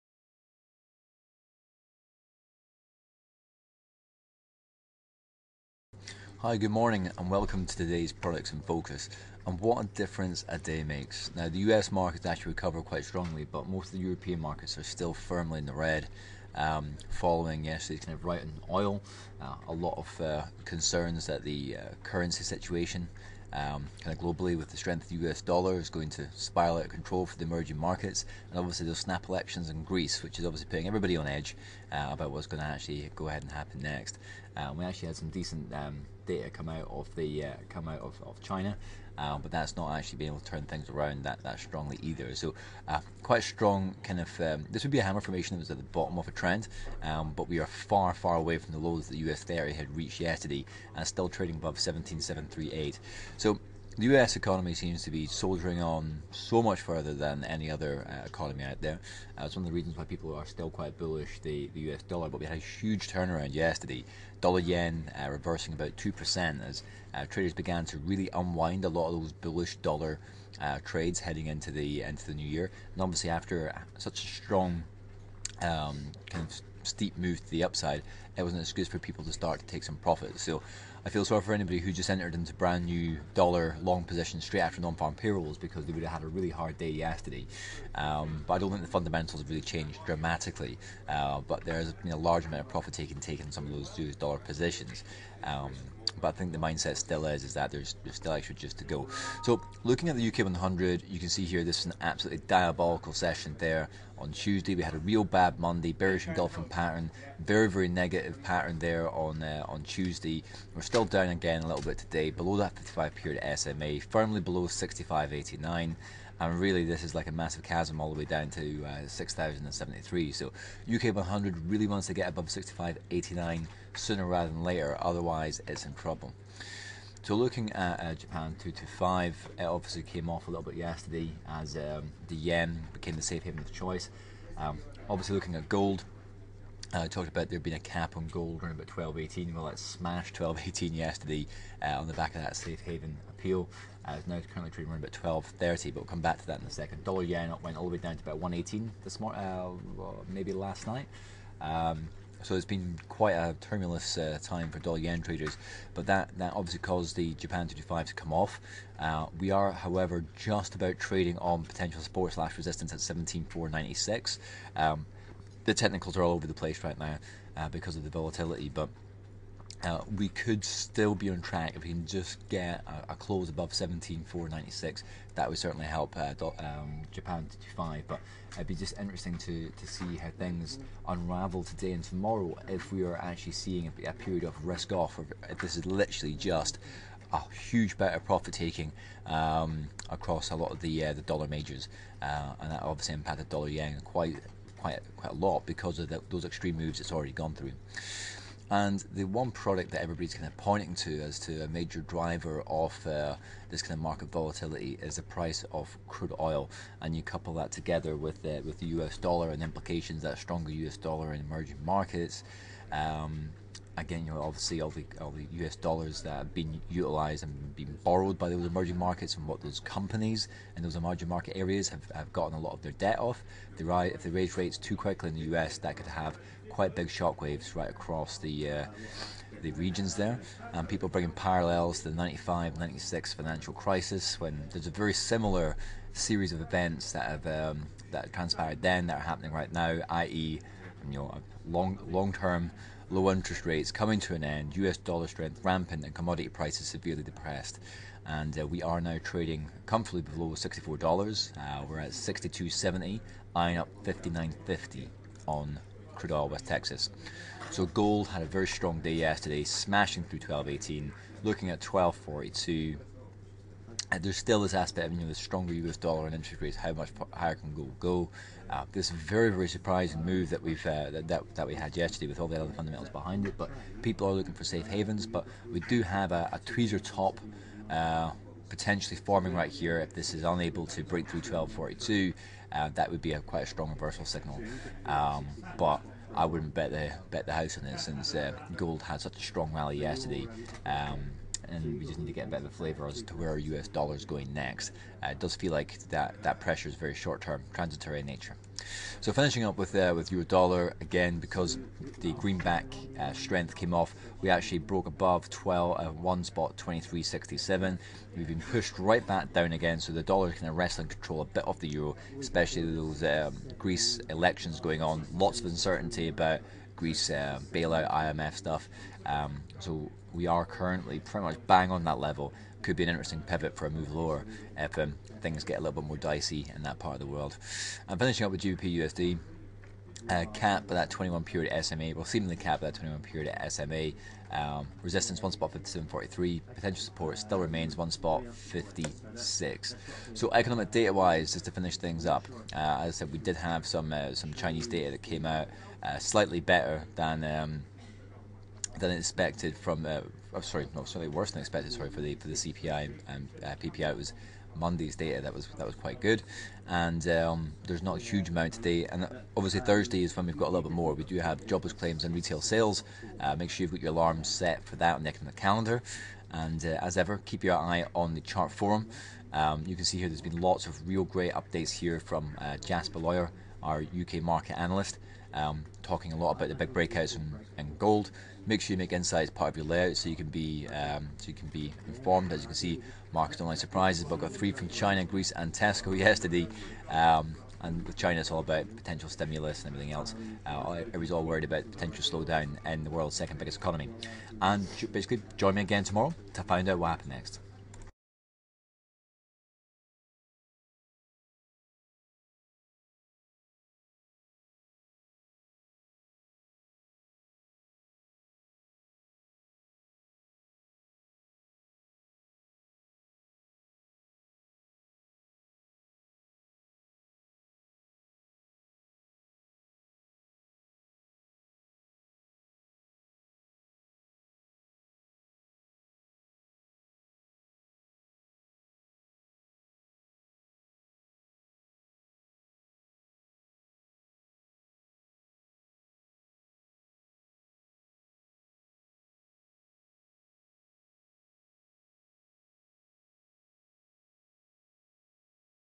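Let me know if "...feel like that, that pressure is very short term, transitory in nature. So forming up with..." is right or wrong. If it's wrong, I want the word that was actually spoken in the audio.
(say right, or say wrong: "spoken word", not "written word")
wrong: "finishing", not "forming".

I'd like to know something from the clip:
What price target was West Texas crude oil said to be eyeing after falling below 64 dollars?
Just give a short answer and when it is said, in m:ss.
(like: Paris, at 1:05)
59.50, at 4:14.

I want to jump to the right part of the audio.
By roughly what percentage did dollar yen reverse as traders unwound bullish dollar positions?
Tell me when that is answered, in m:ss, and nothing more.
1:05.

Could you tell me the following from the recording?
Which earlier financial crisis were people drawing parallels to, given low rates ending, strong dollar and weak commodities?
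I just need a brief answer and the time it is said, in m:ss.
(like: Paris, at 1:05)
95 96 financial crisis, at 3:52.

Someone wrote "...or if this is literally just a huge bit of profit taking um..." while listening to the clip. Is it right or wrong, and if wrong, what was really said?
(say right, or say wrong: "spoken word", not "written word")
right.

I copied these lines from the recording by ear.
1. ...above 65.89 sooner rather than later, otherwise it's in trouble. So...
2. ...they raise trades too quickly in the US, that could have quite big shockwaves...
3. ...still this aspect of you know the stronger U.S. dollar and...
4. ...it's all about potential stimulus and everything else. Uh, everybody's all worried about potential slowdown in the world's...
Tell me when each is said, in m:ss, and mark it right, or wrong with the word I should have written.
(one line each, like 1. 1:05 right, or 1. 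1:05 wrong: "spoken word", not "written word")
1. 2:02 right
2. 3:44 wrong: "rates", not "trades"
3. 4:24 right
4. 6:28 right.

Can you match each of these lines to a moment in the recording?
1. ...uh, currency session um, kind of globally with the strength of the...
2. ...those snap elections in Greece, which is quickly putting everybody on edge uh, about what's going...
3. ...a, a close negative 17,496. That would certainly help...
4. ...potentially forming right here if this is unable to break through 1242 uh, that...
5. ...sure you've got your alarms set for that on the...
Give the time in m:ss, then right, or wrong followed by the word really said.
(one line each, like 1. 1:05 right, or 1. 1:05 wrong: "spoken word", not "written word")
1. 0:21 wrong: "situation", not "session"
2. 0:28 wrong: "obviously", not "quickly"
3. 2:53 wrong: "above", not "negative"
4. 4:38 right
5. 6:03 right.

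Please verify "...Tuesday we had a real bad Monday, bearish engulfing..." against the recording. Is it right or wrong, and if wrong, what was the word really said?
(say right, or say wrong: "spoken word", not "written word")
right.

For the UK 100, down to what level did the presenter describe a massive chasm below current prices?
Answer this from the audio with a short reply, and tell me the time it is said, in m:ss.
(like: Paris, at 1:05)
6,073, at 1:59.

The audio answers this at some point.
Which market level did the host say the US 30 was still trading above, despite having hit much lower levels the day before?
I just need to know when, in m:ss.
0:51.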